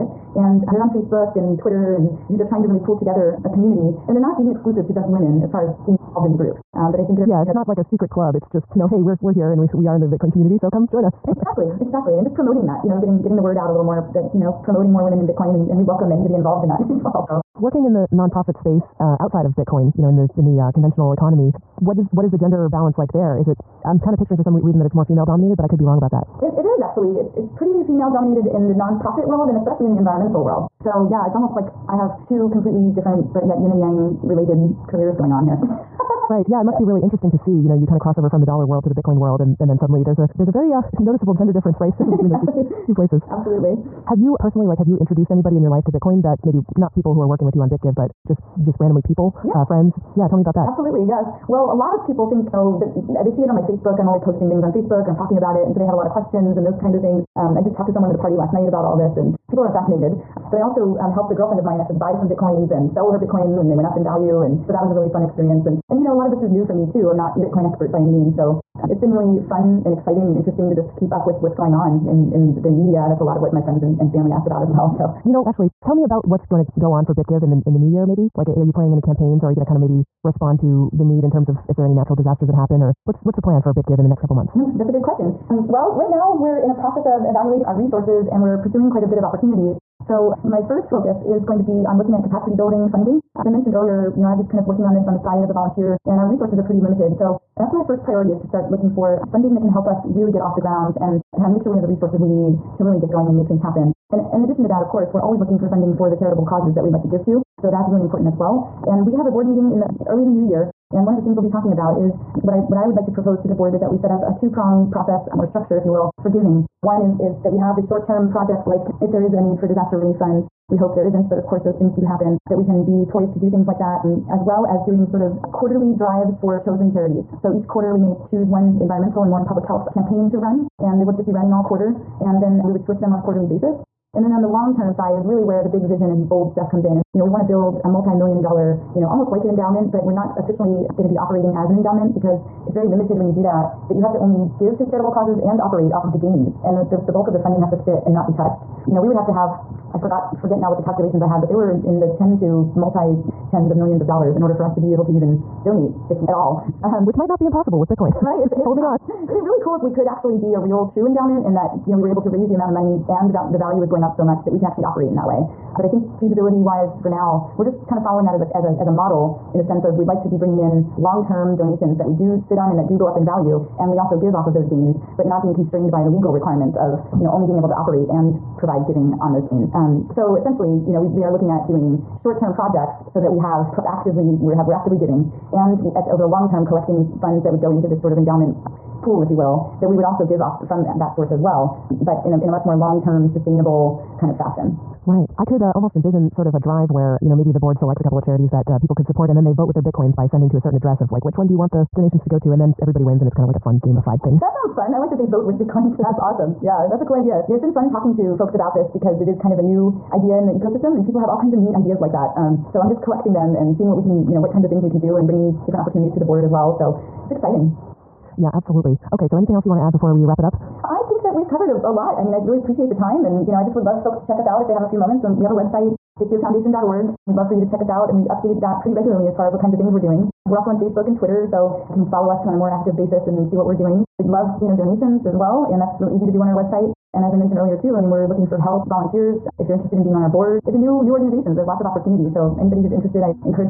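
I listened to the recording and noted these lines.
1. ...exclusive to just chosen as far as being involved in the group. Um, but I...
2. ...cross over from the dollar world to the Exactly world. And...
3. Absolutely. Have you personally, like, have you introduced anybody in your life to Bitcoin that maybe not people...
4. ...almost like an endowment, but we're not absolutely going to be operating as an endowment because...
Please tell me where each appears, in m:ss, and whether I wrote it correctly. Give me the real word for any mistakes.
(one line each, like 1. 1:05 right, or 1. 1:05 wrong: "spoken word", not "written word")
1. 0:04 wrong: "women", not "chosen"
2. 0:37 wrong: "Bitcoin", not "Exactly"
3. 0:43 right
4. 2:19 wrong: "officially", not "absolutely".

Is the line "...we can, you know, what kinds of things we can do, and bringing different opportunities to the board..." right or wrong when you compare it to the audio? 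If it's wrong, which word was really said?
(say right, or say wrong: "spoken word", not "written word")
right.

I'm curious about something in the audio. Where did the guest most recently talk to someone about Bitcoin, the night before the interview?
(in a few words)
A party.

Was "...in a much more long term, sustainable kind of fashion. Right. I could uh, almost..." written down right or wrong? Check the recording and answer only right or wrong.
right.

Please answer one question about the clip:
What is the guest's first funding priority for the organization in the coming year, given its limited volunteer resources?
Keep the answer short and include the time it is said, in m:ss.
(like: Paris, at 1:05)
Capacity building funding, at 1:32.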